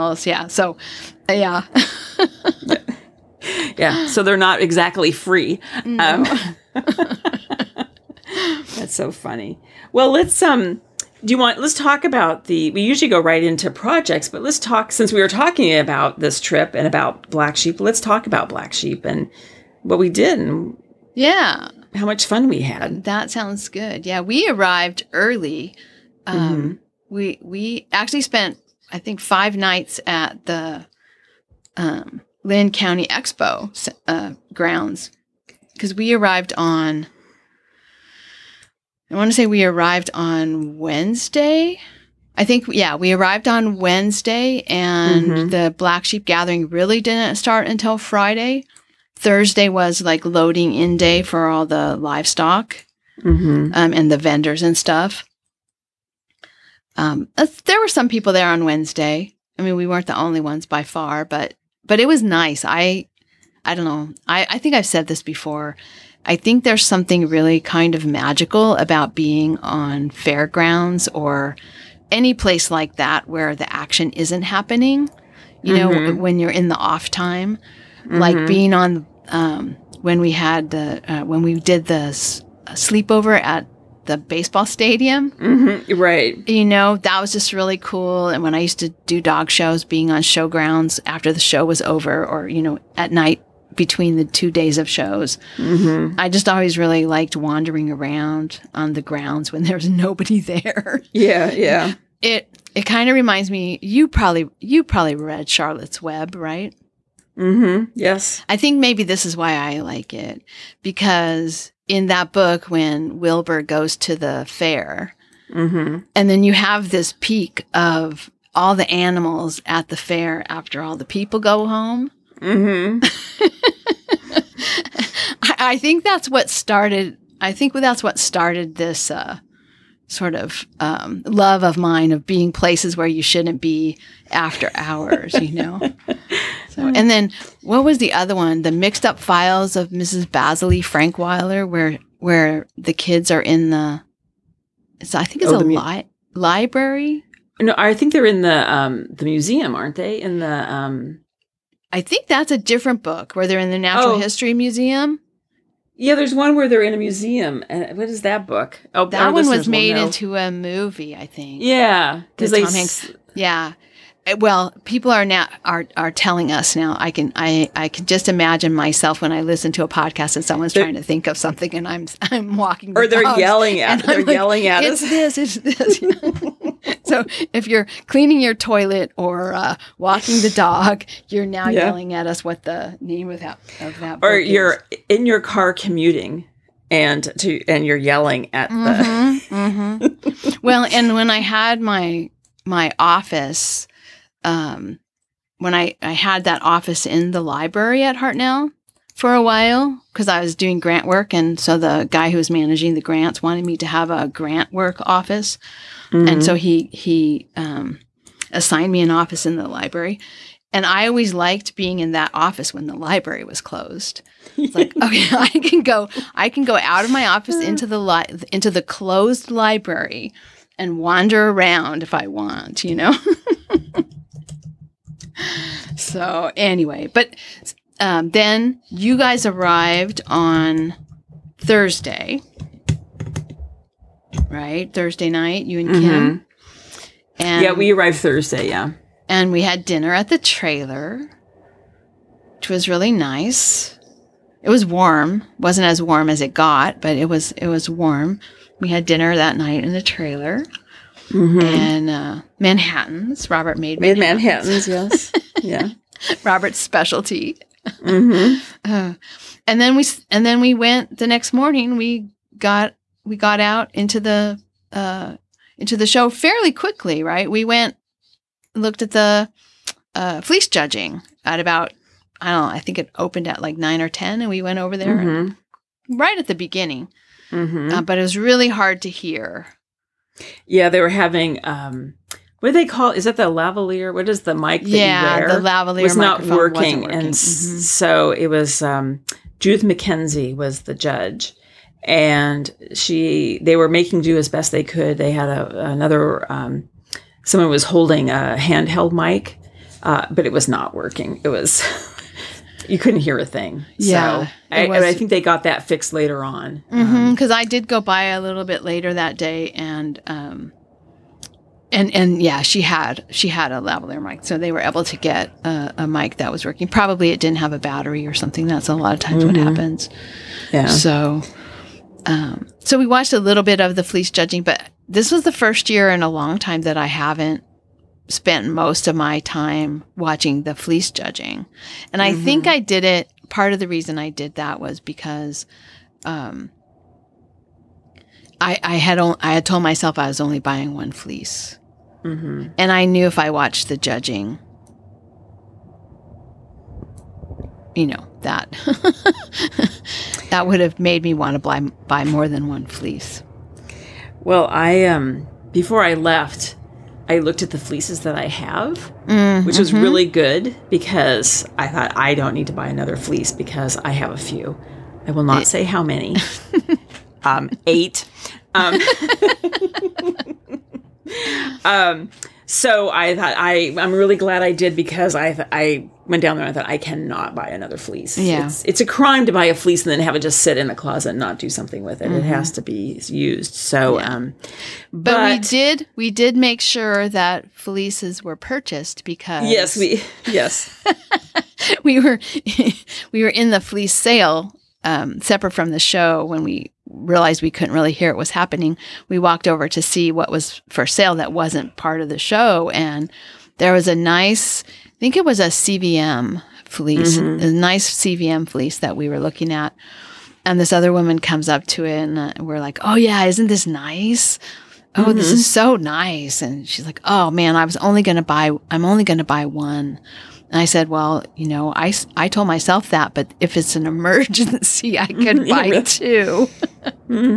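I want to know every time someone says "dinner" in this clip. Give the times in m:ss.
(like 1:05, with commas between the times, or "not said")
3:59, 4:09.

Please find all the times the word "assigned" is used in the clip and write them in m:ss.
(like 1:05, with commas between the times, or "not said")
3:28.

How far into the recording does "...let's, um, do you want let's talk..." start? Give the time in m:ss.
0:10.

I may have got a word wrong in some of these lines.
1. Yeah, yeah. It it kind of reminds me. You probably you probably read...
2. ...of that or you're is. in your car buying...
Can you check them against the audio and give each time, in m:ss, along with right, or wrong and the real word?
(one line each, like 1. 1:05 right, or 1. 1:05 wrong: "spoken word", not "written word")
1. 1:41 right
2. 3:03 wrong: "commuting", not "buying".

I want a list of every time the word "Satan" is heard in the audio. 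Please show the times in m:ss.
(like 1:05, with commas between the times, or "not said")
not said.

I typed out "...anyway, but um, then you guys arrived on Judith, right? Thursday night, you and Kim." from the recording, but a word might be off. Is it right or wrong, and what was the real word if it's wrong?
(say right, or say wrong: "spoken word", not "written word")
wrong: "Thursday", not "Judith".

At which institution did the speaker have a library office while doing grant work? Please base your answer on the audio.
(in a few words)
Hartnell.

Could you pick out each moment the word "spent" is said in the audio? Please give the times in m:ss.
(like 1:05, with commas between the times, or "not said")
0:28, 5:28.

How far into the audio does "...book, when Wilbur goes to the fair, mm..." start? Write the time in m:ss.
1:52.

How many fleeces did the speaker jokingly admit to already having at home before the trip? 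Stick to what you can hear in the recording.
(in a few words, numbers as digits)
8.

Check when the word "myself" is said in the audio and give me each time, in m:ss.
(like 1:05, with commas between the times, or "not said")
2:48, 5:39, 7:02.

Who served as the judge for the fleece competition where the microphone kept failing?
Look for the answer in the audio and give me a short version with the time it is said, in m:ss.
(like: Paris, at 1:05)
Judith MacKenzie, at 4:49.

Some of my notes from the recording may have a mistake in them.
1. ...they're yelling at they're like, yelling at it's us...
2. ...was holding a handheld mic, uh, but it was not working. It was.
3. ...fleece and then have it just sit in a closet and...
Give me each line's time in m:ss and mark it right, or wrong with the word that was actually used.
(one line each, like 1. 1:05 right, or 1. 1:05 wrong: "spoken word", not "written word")
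1. 2:53 right
2. 4:57 right
3. 6:19 right.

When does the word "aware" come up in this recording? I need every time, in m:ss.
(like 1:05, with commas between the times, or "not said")
not said.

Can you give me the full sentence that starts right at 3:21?
And so the guy who was managing the grants wanted me to have a grant work office.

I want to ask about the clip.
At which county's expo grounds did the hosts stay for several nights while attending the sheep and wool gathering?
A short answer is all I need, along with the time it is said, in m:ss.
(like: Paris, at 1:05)
Linn County, at 0:32.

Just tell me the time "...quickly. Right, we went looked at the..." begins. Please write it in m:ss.
4:26.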